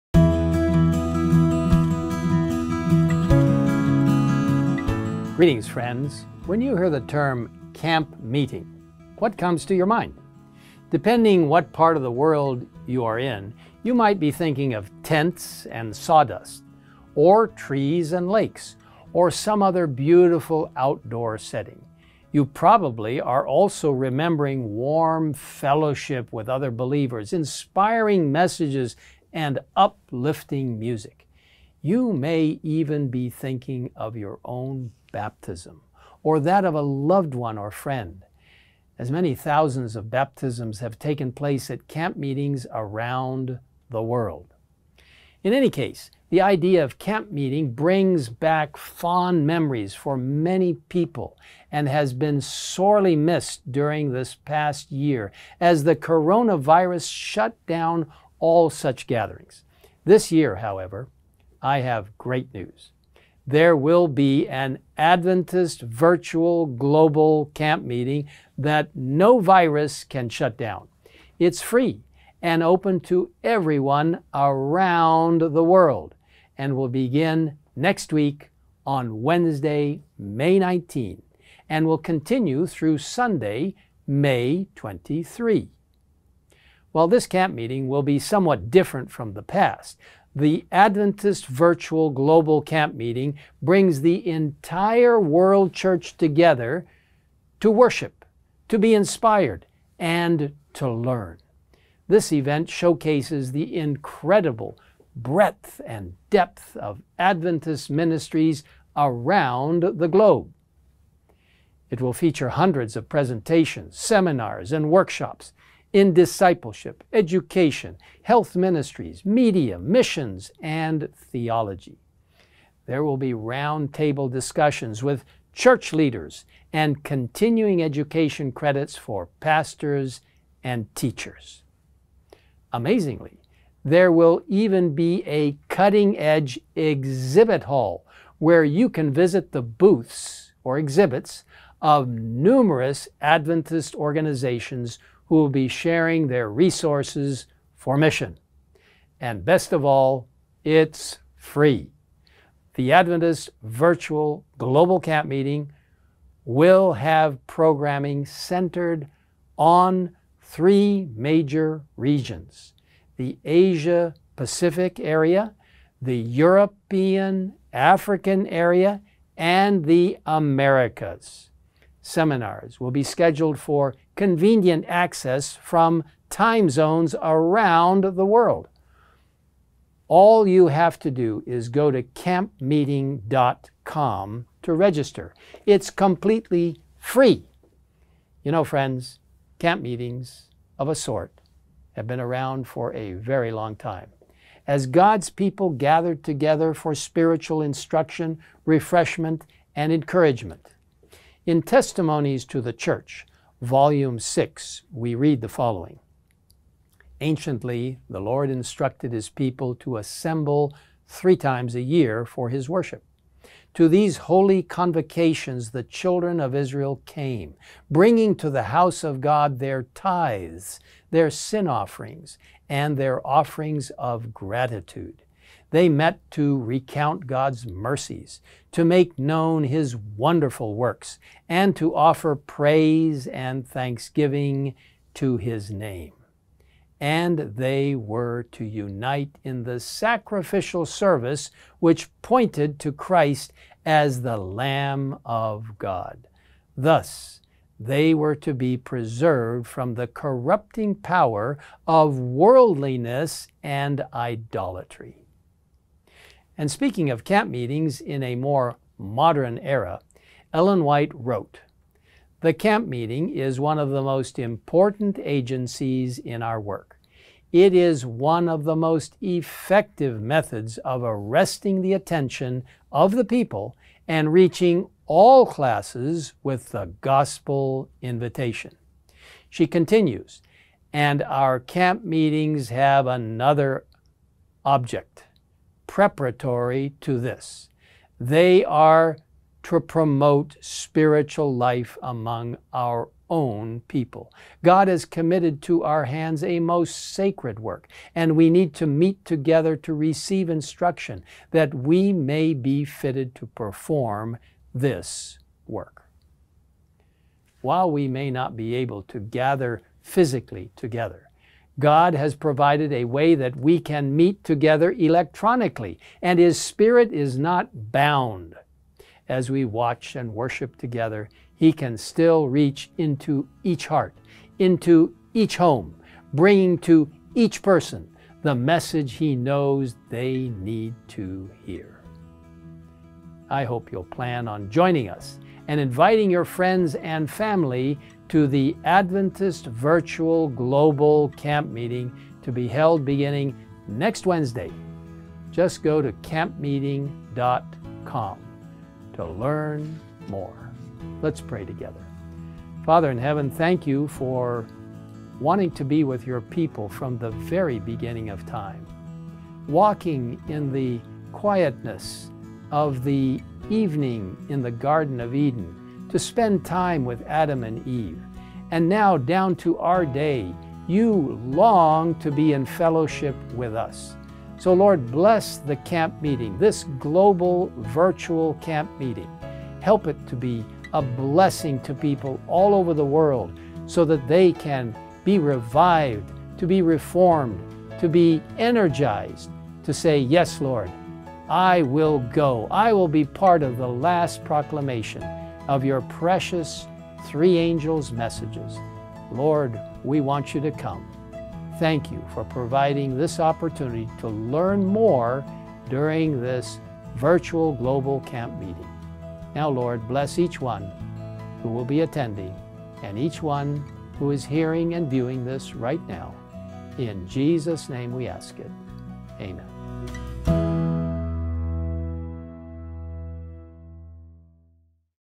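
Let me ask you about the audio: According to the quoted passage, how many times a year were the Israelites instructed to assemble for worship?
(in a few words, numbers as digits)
3.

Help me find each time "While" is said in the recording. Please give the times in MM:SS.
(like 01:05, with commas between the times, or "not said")
01:26, 05:07.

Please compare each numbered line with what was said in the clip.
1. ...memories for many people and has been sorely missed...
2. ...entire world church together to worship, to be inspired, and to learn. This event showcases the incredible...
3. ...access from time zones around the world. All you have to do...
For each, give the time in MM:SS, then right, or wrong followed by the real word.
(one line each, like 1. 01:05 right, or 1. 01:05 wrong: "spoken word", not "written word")
1. 00:49 right
2. 01:34 right
3. 02:54 right.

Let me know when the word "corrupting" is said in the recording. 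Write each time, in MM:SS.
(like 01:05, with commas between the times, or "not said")
04:10.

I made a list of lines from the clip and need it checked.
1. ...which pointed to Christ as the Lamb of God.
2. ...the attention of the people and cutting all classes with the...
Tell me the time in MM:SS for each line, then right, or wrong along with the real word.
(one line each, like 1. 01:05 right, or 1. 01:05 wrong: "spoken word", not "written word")
1. 04:01 right
2. 04:31 wrong: "reaching", not "cutting".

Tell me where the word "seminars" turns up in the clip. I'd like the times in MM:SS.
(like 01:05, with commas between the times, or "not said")
01:53, 02:52.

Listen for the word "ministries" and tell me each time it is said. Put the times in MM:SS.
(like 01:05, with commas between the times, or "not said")
01:47, 01:58.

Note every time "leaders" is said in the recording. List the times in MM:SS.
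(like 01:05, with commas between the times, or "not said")
02:05.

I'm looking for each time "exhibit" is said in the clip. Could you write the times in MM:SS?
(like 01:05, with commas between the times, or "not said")
02:16, 02:20.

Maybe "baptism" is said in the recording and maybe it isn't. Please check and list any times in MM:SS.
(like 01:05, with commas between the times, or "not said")
00:35, 00:40.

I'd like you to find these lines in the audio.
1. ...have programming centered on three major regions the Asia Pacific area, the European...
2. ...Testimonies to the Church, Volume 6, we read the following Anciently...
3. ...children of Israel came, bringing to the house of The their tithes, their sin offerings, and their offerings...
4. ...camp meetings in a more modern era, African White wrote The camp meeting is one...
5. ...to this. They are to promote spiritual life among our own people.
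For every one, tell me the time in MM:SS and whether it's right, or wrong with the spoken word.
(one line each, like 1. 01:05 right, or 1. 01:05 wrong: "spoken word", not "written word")
1. 02:36 right
2. 03:21 right
3. 03:35 wrong: "God", not "The"
4. 04:17 wrong: "Ellen", not "African"
5. 04:47 right.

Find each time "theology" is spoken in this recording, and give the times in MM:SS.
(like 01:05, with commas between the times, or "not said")
02:01.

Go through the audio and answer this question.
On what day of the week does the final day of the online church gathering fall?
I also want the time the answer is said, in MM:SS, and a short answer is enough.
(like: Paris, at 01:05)
Sunday, at 01:22.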